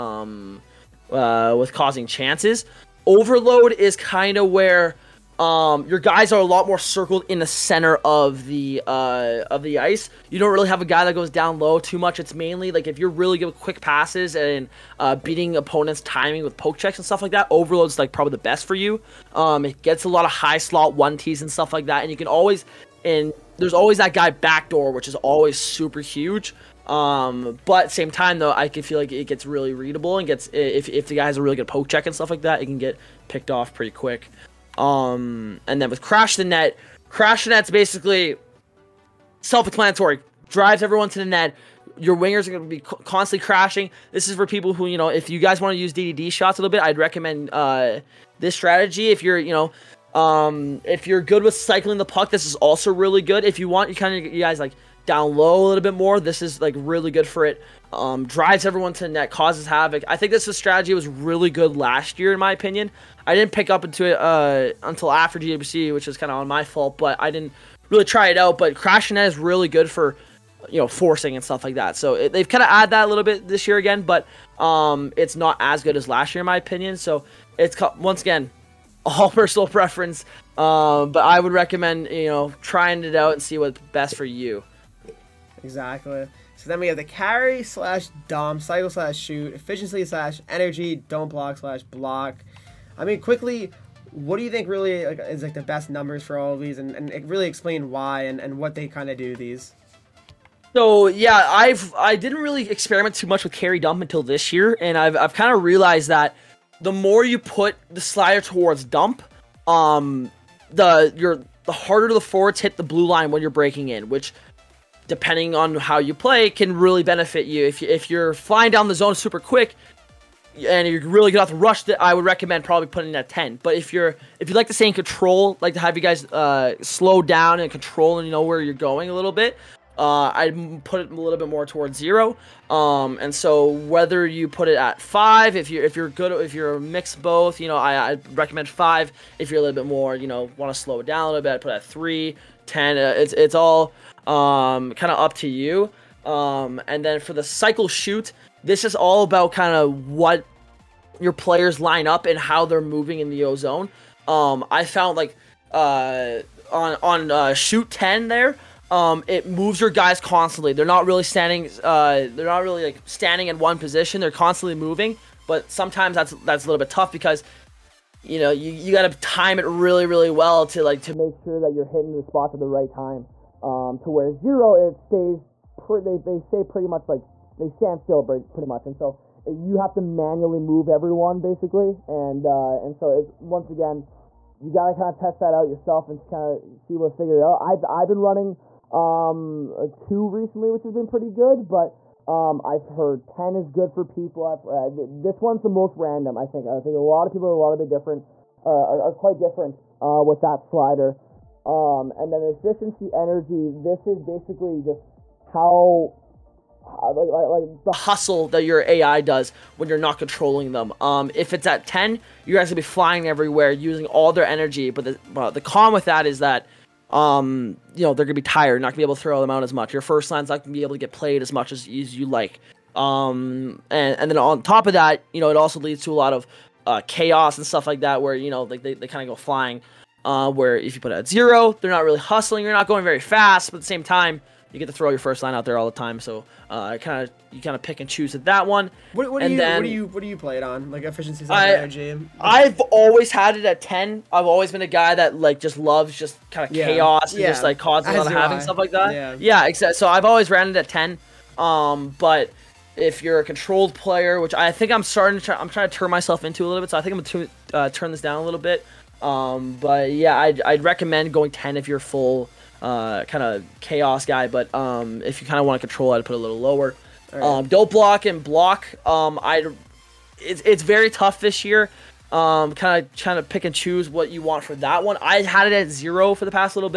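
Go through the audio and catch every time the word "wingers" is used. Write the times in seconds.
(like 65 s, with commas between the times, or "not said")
42 s.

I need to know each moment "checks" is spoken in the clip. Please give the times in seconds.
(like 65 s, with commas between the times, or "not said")
16 s, 31 s.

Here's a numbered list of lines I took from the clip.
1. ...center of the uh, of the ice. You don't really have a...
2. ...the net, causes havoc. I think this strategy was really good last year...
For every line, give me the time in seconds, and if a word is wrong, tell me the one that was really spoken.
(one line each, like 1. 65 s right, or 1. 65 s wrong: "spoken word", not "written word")
1. 7 s right
2. 59 s right.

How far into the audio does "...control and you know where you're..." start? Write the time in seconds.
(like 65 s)
127 s.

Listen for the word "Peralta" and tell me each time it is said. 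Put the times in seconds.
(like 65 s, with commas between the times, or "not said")
not said.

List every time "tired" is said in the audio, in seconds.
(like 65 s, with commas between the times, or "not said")
218 s.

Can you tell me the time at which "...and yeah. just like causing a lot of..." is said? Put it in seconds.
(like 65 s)
247 s.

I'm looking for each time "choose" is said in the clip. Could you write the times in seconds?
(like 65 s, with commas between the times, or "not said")
238 s, 273 s.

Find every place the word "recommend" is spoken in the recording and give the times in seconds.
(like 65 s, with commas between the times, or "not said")
46 s, 81 s, 122 s, 138 s, 260 s.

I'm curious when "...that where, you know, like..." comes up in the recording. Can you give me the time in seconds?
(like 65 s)
227 s.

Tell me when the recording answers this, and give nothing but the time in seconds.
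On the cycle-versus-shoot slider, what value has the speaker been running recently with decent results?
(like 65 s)
189 s.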